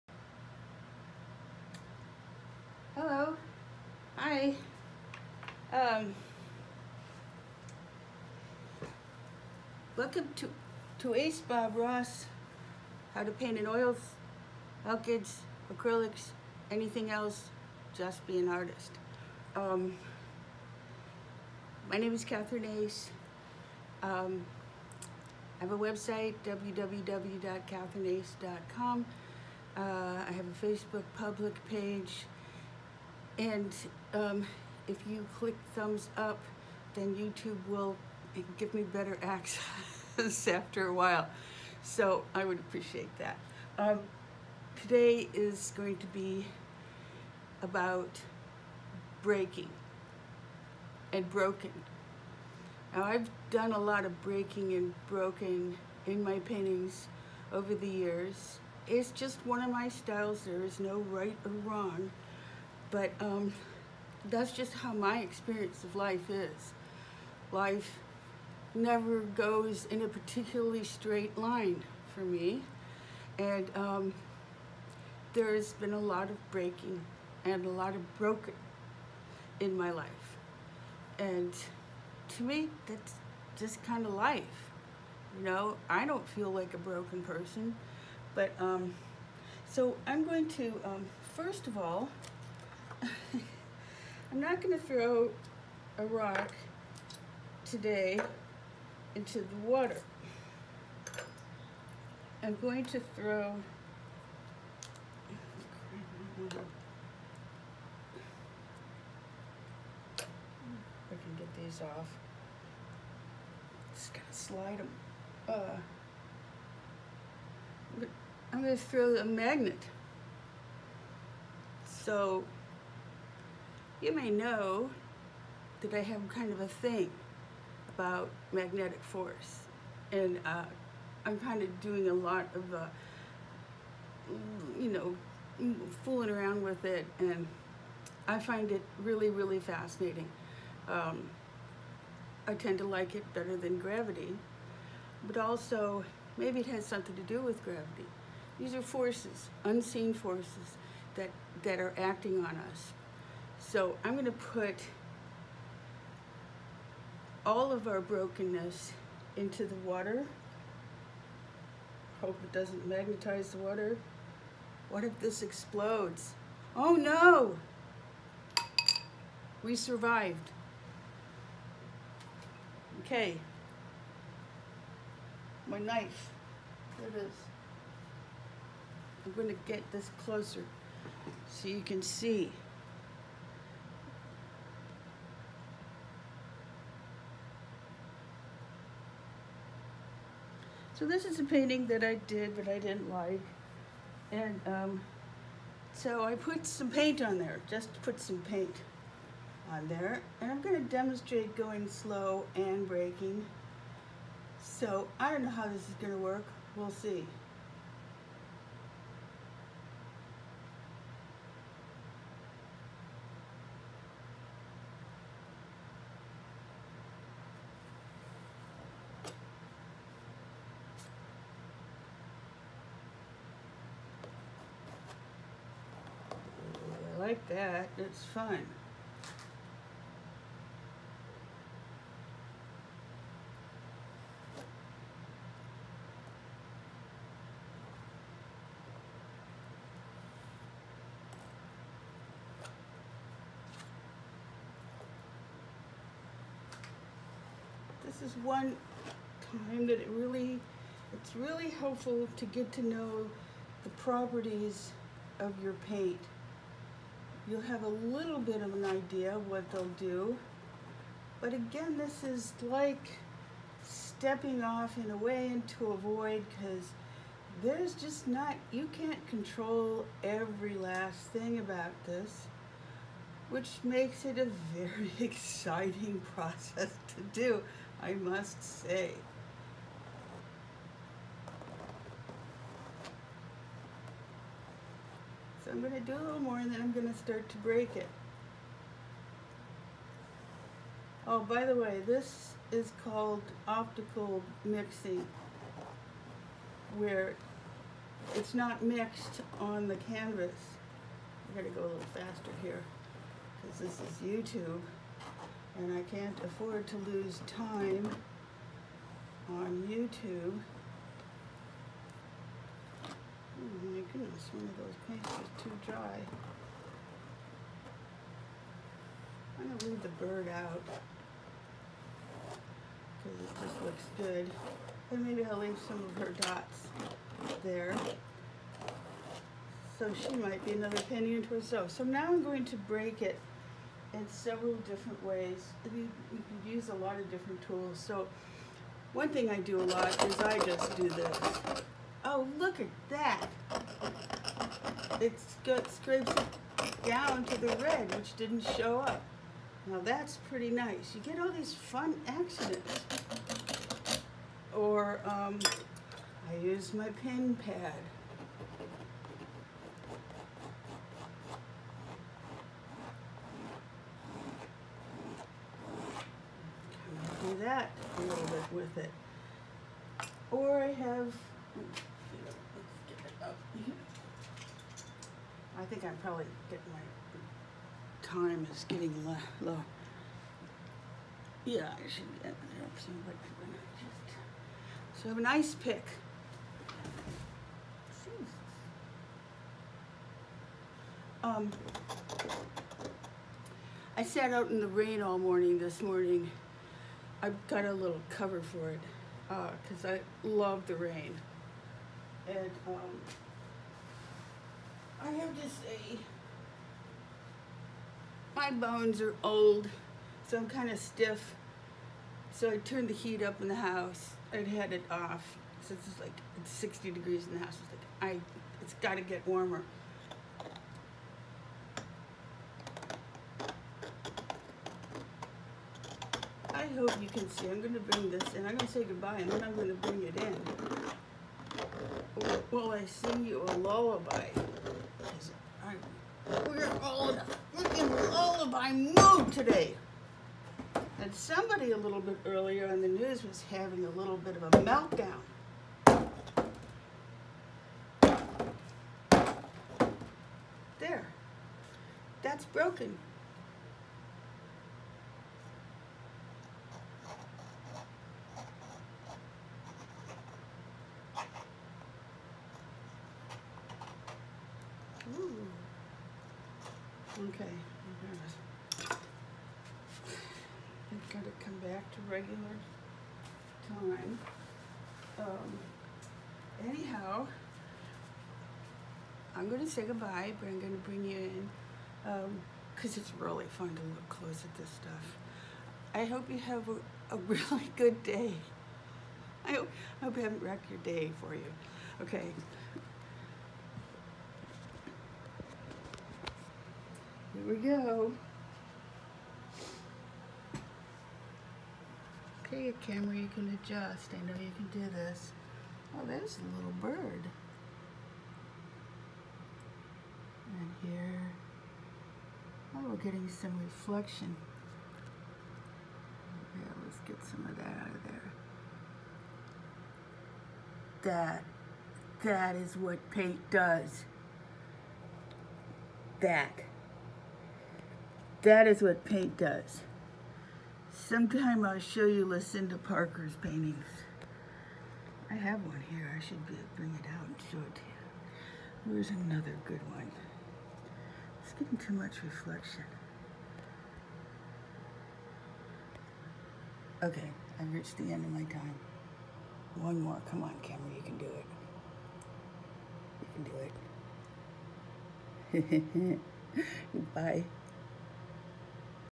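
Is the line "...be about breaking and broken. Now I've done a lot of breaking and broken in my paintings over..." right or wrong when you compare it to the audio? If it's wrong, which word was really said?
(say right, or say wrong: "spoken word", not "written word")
right.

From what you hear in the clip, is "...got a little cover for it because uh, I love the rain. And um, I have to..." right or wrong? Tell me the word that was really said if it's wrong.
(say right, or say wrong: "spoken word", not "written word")
right.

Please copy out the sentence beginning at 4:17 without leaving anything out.
You'll have a little bit of an idea what they'll do.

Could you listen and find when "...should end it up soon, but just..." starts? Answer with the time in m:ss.
6:22.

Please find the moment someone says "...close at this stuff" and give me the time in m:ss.
8:04.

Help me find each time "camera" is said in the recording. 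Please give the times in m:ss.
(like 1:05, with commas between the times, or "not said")
8:23, 9:10.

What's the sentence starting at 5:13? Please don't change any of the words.
Oh my goodness, one of those paints is too dry.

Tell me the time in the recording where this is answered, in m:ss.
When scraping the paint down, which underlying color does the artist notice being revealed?
5:47.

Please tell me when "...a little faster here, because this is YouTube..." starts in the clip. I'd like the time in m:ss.
5:01.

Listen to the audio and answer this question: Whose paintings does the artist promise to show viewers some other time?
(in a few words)
Lucinda Parker.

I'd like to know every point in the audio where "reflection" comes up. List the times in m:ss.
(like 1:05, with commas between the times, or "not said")
8:33, 9:02.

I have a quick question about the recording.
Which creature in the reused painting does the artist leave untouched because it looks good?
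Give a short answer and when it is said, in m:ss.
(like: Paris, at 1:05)
The bird, at 5:20.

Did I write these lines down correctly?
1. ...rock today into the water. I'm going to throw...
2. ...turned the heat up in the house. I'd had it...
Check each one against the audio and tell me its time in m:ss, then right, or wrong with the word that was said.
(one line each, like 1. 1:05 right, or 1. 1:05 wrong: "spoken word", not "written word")
1. 1:36 right
2. 6:52 right.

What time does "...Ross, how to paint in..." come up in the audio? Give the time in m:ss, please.
0:11.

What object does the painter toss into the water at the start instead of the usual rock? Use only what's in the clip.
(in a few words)
A magnet.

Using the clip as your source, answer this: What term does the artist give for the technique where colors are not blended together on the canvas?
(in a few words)
Optical mixing.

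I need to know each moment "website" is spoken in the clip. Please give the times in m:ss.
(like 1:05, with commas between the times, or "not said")
0:25.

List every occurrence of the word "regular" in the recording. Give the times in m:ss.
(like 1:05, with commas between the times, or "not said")
7:52.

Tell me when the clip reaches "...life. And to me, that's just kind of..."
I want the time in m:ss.
1:19.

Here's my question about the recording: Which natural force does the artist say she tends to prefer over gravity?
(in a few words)
Magnetic force.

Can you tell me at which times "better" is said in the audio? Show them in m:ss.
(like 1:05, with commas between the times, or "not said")
0:38, 2:23.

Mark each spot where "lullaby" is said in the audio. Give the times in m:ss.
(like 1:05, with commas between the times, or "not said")
7:13, 7:18.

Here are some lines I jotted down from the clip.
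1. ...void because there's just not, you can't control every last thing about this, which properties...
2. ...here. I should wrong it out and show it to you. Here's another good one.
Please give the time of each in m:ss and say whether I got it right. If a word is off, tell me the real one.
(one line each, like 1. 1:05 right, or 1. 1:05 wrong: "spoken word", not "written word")
1. 4:25 wrong: "makes", not "properties"
2. 8:56 wrong: "bring", not "wrong".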